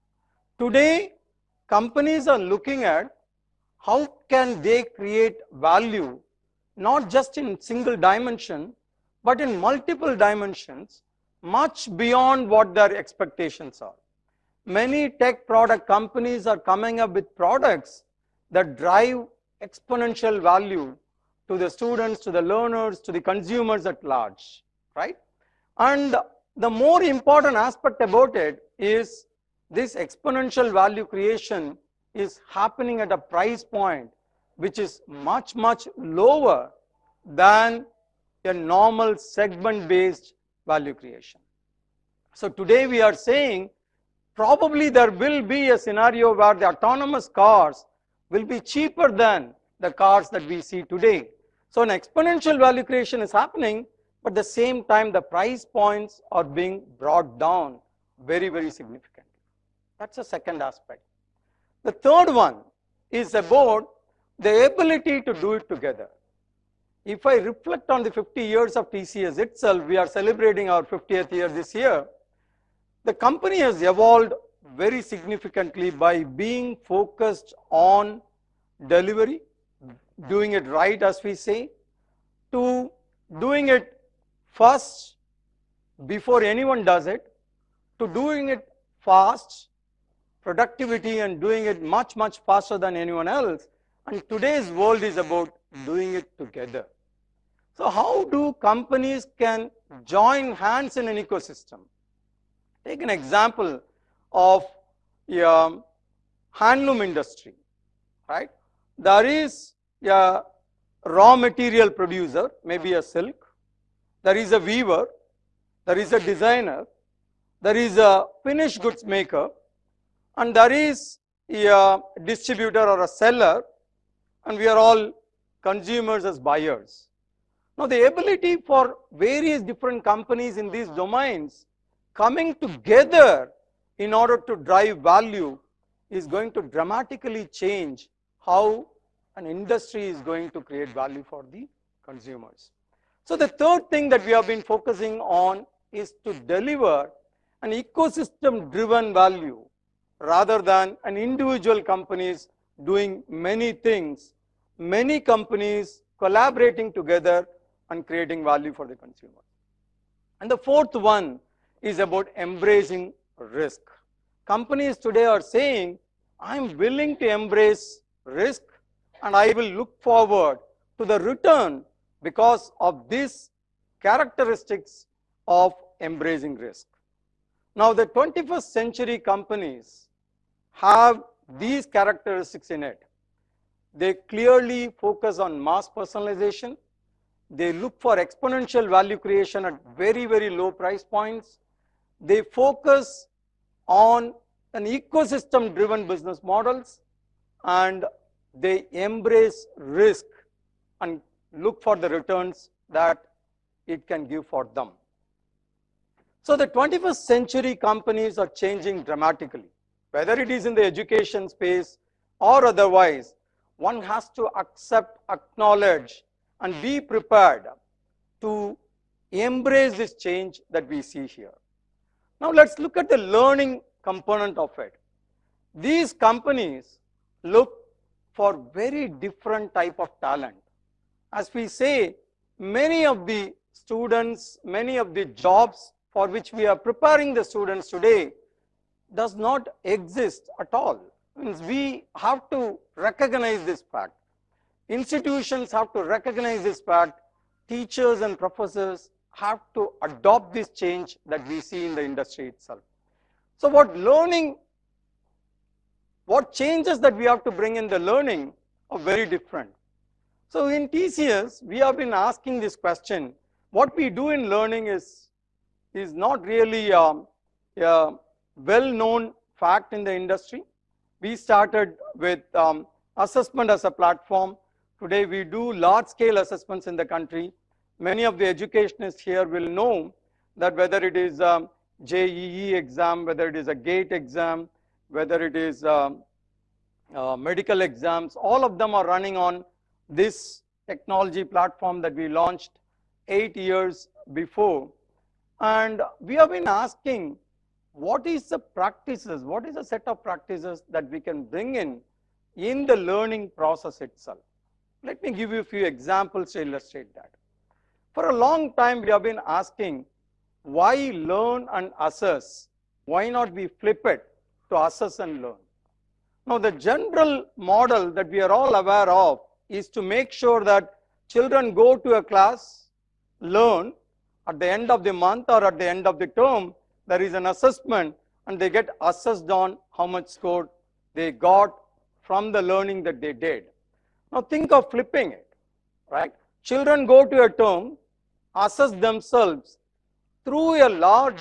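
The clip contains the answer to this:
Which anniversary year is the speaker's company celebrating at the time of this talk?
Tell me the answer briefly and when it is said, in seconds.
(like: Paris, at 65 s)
50th, at 70 s.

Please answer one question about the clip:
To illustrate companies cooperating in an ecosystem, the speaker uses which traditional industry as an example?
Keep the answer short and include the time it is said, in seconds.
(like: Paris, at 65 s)
Handloom industry, at 106 s.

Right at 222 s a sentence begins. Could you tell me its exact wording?
Now let's look at the learning component of it.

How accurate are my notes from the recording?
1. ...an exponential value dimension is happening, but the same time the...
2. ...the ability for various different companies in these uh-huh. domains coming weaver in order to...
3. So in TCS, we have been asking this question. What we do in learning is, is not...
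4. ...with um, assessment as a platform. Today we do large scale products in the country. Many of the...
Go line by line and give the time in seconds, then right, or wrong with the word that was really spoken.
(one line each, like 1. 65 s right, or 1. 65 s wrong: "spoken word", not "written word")
1. 51 s wrong: "creation", not "dimension"
2. 127 s wrong: "together", not "weaver"
3. 260 s right
4. 272 s wrong: "assessments", not "products".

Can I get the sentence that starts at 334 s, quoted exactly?
Now think of flipping it, right?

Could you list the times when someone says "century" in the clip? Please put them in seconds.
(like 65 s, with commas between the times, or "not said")
178 s, 207 s.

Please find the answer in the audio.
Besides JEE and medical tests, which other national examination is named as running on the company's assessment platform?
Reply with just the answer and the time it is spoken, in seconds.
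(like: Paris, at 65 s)
GATE, at 283 s.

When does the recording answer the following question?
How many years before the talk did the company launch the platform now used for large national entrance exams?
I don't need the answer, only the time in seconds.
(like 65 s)
293 s.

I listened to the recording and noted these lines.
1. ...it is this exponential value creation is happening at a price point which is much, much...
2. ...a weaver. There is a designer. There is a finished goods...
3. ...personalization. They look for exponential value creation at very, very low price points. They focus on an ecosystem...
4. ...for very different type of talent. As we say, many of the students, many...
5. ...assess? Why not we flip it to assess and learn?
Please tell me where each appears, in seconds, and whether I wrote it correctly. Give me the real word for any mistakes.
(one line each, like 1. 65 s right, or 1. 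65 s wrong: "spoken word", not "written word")
1. 28 s right
2. 114 s right
3. 185 s right
4. 228 s right
5. 311 s right.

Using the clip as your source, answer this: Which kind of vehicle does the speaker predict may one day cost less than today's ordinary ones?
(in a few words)
Autonomous cars.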